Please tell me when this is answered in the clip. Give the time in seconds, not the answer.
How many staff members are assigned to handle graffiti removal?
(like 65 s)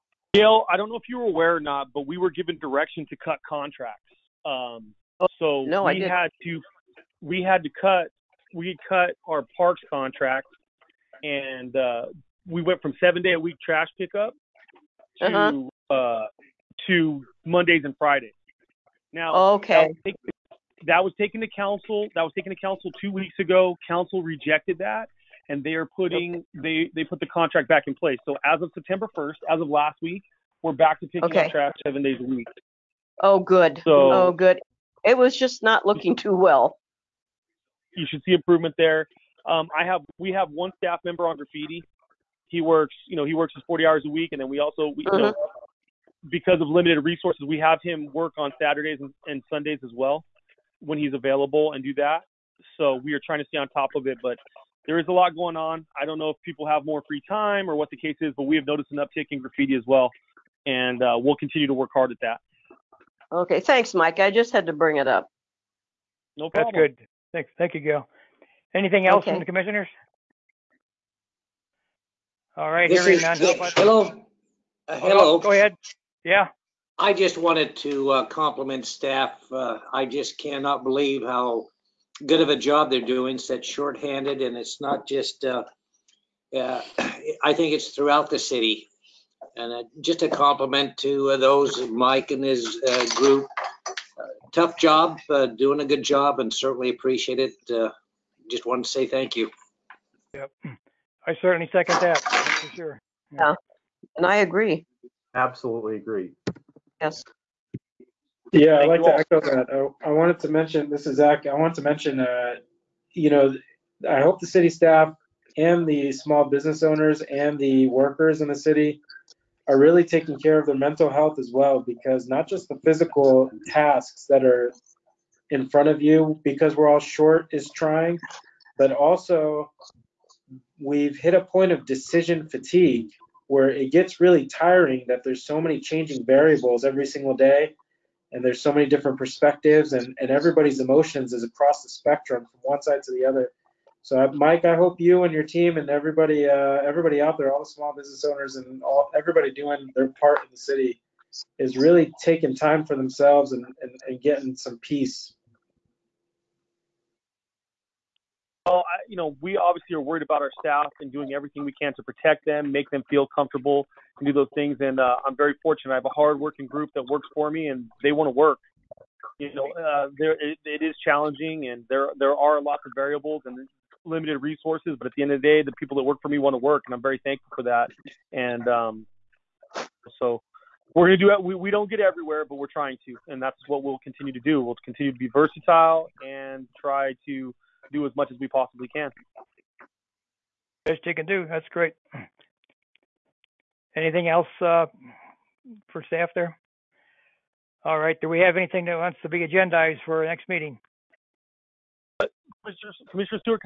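40 s.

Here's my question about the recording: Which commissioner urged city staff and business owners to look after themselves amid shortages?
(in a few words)
Zach.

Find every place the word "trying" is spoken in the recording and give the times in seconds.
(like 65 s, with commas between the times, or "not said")
53 s, 127 s, 182 s.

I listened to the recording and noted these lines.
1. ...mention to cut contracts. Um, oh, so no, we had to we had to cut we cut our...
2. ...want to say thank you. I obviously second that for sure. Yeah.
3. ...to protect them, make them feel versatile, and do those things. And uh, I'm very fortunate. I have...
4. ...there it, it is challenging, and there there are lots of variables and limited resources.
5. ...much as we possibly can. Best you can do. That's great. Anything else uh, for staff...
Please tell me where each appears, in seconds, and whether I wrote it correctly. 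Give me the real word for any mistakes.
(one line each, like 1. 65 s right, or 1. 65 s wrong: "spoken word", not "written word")
1. 2 s wrong: "direction", not "mention"
2. 98 s wrong: "certainly", not "obviously"
3. 161 s wrong: "comfortable", not "versatile"
4. 170 s right
5. 188 s right.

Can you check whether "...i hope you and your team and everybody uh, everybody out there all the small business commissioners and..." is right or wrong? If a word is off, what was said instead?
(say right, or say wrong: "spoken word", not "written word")
wrong: "owners", not "commissioners".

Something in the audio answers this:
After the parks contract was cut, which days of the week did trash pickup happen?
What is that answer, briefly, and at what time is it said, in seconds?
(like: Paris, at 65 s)
Mondays and Fridays, at 17 s.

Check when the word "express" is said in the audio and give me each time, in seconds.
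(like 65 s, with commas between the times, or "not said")
not said.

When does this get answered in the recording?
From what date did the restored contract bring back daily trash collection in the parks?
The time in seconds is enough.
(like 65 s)
28 s.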